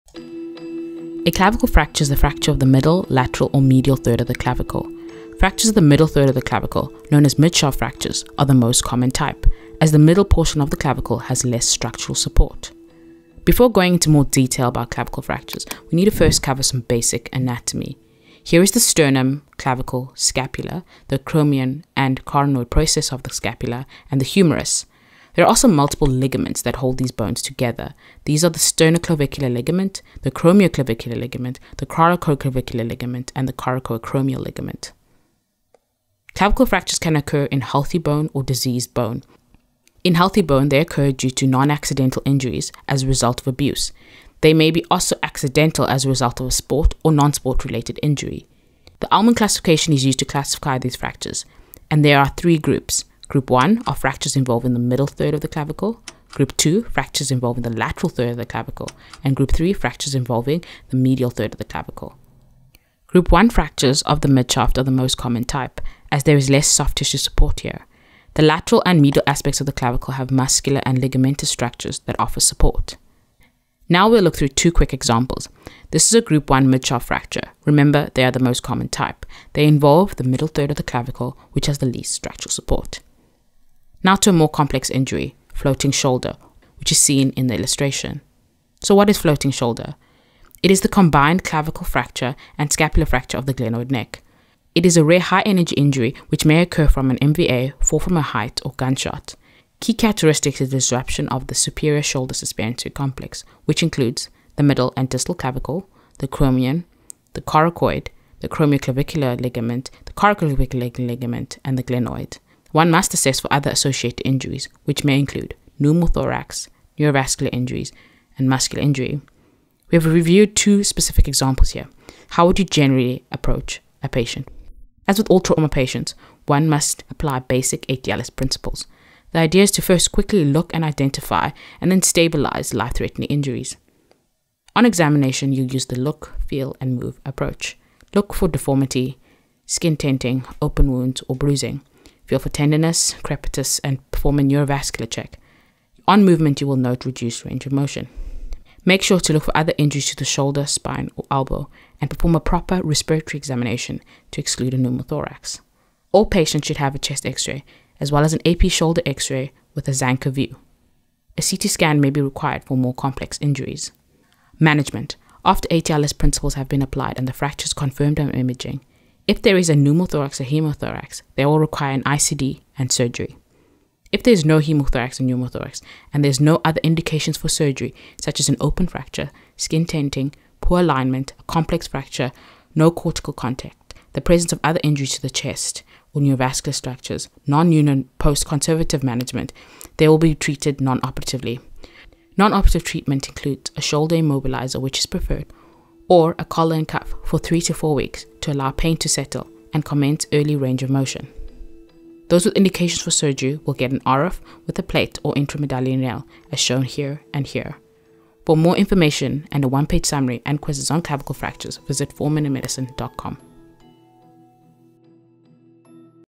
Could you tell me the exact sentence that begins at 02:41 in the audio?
A CT scan may be required for more complex injuries.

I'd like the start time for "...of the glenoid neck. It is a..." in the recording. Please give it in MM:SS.
01:33.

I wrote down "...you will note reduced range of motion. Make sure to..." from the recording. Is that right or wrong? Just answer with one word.
right.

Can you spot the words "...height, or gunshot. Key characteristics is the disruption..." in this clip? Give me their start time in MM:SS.
01:38.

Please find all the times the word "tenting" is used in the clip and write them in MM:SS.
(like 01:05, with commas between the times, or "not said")
02:19, 02:59.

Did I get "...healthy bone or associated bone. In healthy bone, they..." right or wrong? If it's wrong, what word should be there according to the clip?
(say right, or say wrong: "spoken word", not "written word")
wrong: "diseased", not "associated".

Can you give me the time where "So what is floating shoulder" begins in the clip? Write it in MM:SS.
01:28.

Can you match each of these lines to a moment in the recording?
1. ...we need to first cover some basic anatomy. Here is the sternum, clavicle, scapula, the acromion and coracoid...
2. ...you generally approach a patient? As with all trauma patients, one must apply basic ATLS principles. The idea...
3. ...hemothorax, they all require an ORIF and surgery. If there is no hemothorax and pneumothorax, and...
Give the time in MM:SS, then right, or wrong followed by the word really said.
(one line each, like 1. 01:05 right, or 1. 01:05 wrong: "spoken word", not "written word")
1. 00:15 right
2. 02:02 right
3. 02:50 wrong: "ICD", not "ORIF".